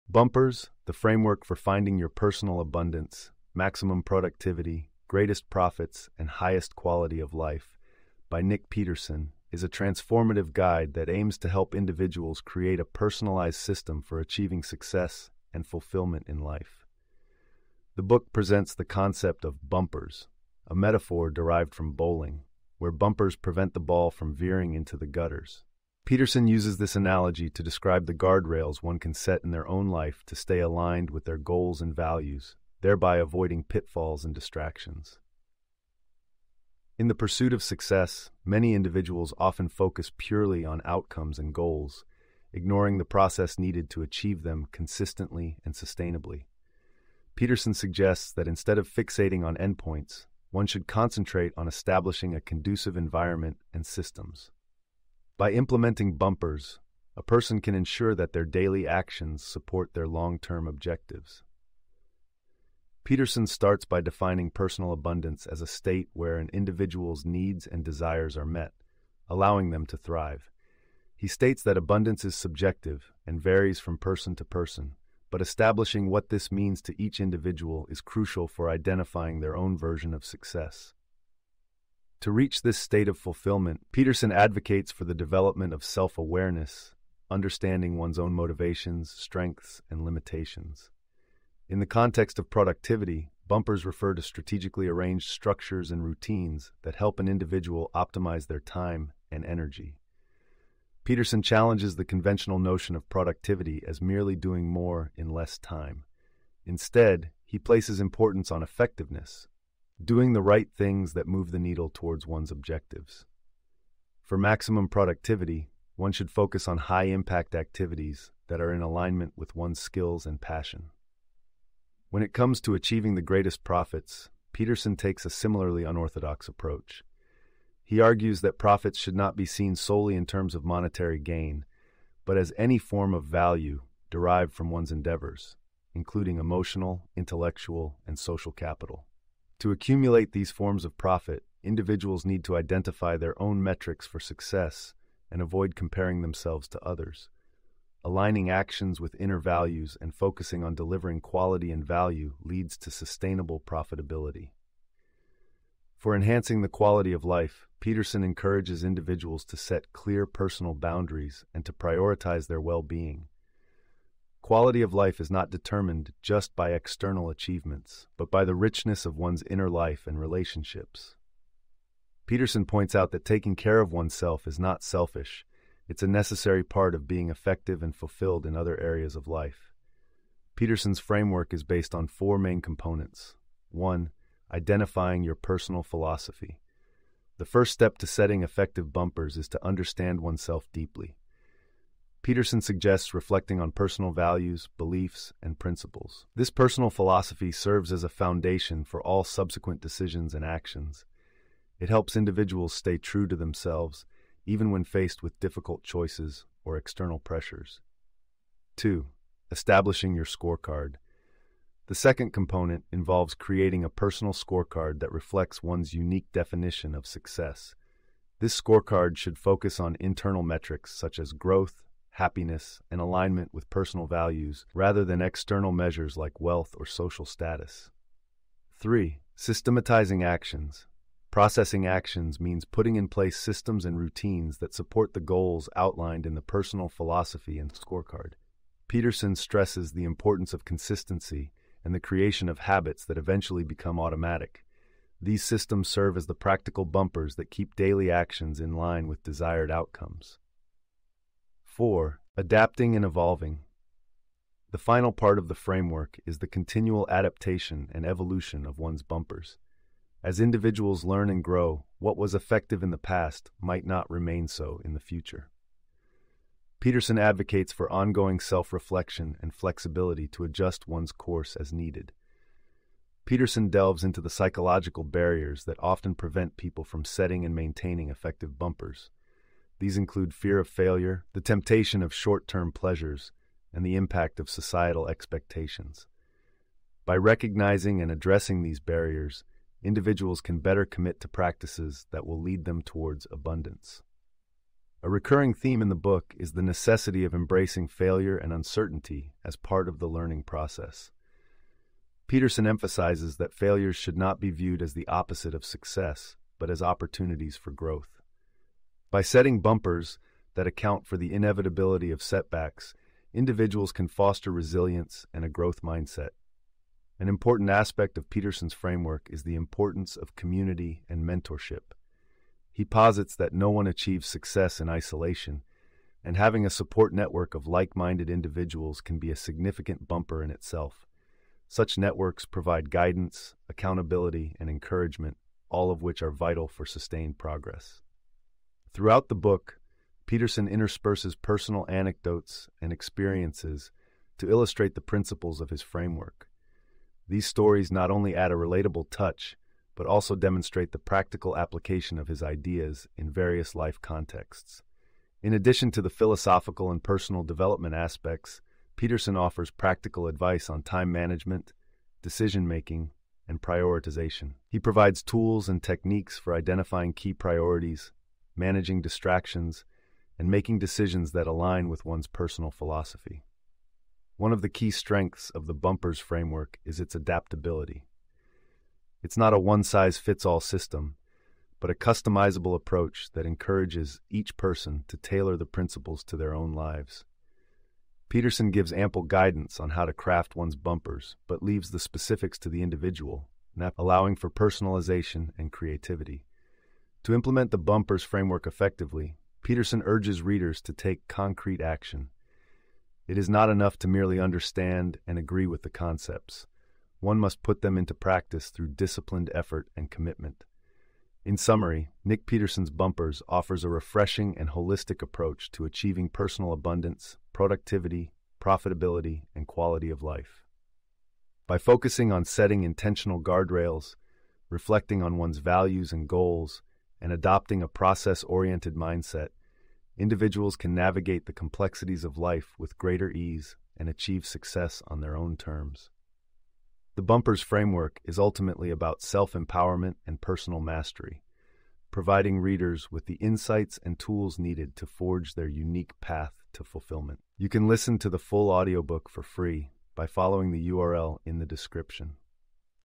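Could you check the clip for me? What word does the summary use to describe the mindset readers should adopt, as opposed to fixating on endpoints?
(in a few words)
Process oriented.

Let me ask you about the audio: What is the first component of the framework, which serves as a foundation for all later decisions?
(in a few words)
Identifying your personal philosophy.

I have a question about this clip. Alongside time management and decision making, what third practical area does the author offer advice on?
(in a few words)
Prioritization.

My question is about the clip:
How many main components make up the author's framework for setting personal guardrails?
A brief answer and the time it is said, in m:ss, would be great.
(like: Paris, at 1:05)
4, at 3:02.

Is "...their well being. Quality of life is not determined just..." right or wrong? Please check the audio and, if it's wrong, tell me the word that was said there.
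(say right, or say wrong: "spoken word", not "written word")
right.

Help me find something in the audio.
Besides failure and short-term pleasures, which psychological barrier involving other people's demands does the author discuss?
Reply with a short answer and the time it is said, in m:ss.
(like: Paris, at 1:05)
Societal expectations, at 4:44.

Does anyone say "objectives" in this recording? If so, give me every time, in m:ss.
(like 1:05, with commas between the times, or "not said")
1:00, 1:52.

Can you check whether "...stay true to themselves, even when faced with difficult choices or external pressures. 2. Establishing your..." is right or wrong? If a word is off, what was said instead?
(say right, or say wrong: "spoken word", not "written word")
right.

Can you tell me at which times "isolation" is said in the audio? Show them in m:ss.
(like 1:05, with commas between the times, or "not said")
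5:24.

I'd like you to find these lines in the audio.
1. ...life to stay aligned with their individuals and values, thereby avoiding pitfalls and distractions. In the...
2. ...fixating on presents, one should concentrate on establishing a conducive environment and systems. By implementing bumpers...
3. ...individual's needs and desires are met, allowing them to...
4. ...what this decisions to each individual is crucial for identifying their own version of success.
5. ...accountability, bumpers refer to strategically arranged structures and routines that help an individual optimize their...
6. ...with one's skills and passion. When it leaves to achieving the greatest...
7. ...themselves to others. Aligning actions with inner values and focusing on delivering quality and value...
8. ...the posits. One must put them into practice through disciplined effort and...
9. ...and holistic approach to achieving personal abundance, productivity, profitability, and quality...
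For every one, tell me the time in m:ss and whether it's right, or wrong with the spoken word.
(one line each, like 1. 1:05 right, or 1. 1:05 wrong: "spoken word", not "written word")
1. 0:29 wrong: "goals", not "individuals"
2. 0:48 wrong: "endpoints", not "presents"
3. 1:06 right
4. 1:16 wrong: "means", not "decisions"
5. 1:32 wrong: "productivity", not "accountability"
6. 1:59 wrong: "comes", not "leaves"
7. 2:26 right
8. 6:45 wrong: "concepts", not "posits"
9. 6:54 right.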